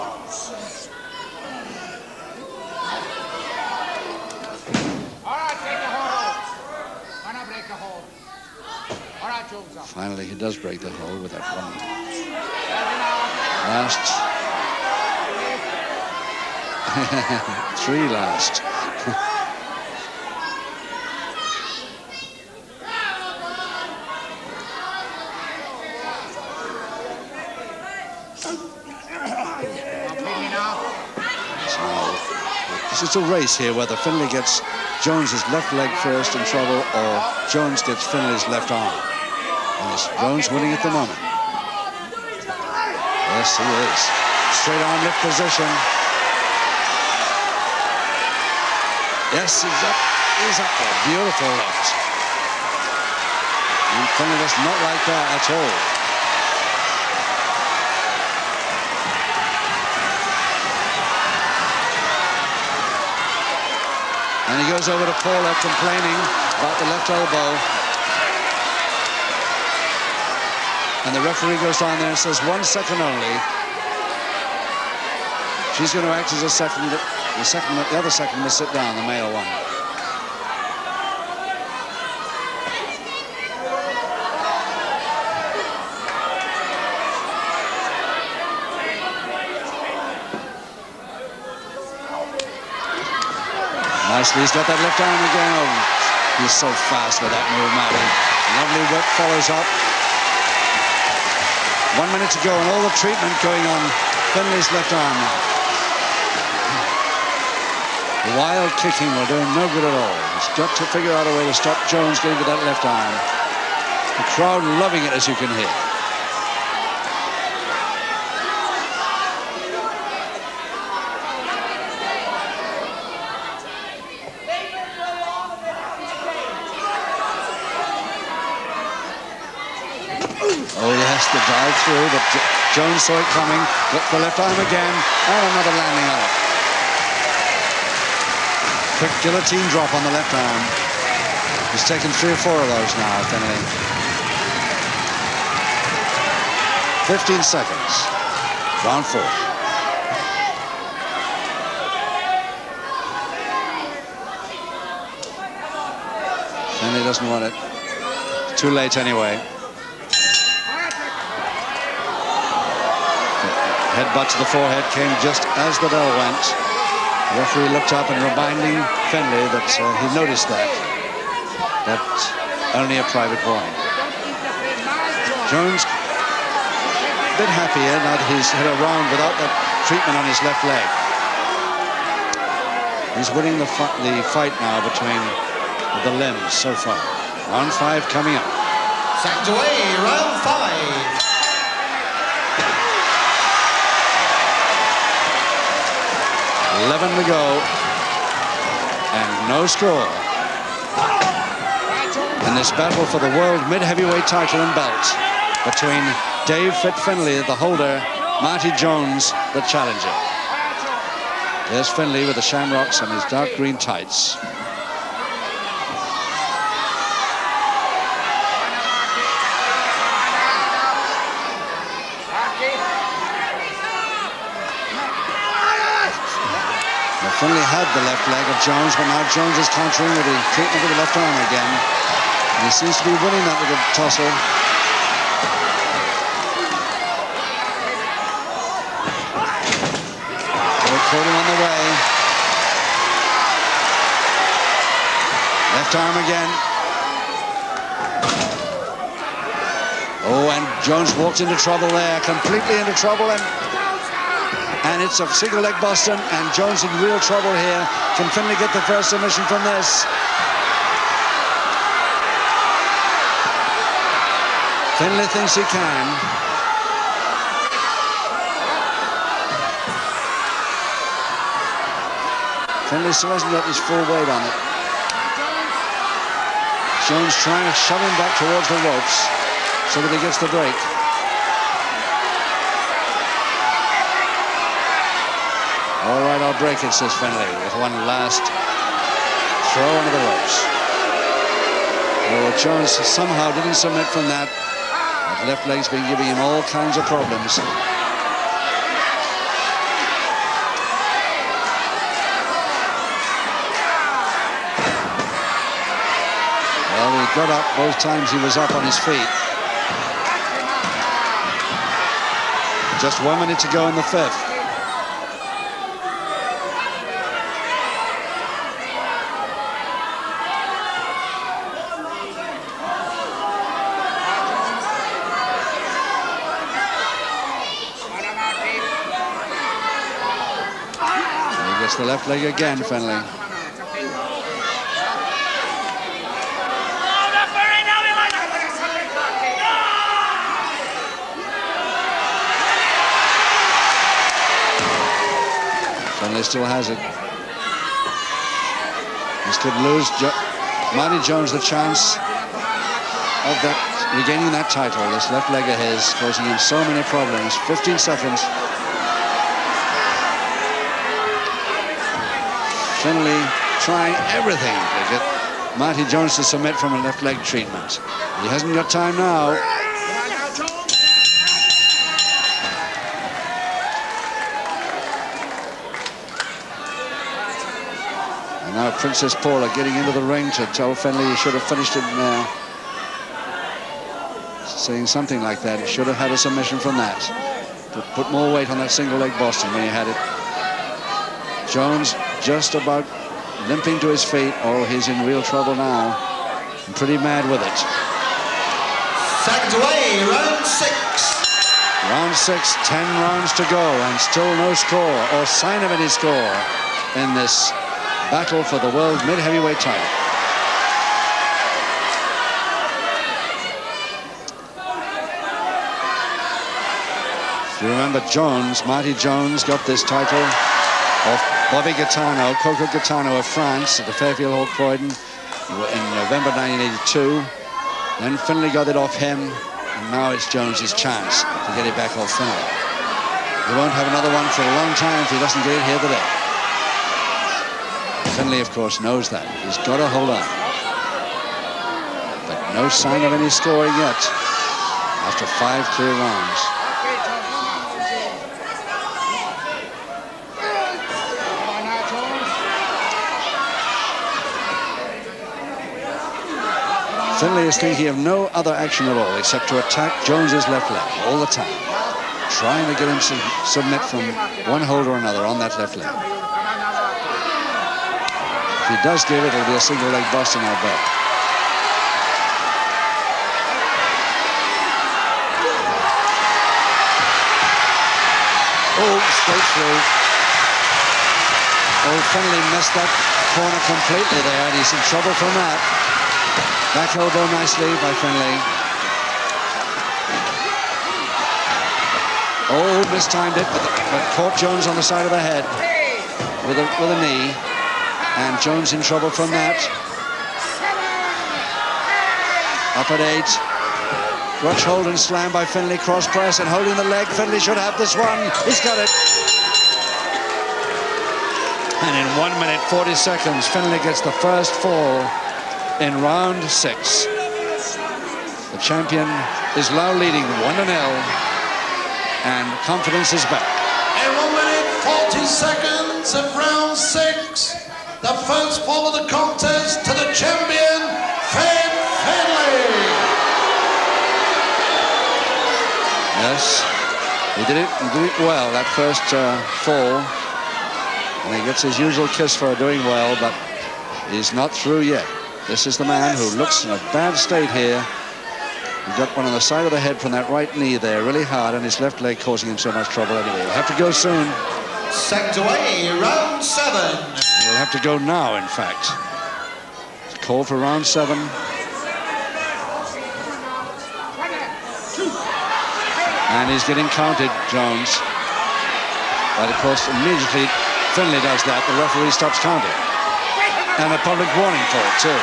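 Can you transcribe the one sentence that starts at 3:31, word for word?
There's Finlay with the shamrocks and his dark green tights.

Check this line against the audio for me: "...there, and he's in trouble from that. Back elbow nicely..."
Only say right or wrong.
right.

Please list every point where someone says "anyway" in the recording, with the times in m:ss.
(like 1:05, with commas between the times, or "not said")
2:38, 9:13.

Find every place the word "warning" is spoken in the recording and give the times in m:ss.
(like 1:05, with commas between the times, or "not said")
2:53, 9:34.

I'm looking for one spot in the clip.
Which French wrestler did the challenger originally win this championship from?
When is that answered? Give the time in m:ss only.
7:02.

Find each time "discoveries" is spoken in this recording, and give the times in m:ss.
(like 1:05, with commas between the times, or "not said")
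not said.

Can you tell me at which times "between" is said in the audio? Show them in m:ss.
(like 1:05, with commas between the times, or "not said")
3:04, 3:25.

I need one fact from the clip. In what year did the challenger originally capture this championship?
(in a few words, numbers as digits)
1982.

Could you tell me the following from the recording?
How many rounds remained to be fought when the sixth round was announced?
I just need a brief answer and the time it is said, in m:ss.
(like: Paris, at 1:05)
10, at 6:42.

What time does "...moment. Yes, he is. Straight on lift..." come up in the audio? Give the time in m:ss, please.
0:40.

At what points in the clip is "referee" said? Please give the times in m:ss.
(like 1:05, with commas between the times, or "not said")
1:11, 2:47, 9:32.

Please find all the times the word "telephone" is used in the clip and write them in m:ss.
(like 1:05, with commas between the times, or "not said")
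not said.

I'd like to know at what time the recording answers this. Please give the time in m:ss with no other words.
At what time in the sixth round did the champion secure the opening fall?
8:32.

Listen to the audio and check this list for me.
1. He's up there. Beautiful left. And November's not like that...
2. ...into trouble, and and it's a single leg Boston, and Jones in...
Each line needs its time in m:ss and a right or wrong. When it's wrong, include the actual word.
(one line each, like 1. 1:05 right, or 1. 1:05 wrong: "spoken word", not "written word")
1. 0:50 wrong: "Finnegan", not "November"
2. 4:12 right.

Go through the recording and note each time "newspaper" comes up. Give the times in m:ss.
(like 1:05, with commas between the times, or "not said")
not said.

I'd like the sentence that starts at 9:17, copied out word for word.
We'll have to go now, in fact.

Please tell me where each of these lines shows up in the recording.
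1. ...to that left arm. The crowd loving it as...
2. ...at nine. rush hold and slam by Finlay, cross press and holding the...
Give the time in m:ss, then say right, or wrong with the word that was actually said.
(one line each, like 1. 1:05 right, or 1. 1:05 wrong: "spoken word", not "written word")
1. 1:52 right
2. 8:23 wrong: "eight", not "nine".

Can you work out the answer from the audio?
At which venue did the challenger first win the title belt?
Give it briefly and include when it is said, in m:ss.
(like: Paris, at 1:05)
Fairfield Hall Croydon, at 7:04.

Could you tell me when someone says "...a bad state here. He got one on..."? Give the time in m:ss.
9:06.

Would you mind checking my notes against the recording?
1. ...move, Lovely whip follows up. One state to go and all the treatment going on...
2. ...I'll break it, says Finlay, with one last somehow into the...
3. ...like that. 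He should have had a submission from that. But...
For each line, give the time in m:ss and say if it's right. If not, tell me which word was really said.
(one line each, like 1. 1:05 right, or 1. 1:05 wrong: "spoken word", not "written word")
1. 1:37 wrong: "minute", not "state"
2. 4:46 wrong: "throw", not "somehow"
3. 6:25 right.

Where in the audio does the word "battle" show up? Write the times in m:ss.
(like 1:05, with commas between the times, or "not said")
3:22, 6:48.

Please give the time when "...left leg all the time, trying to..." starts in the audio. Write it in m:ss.
7:40.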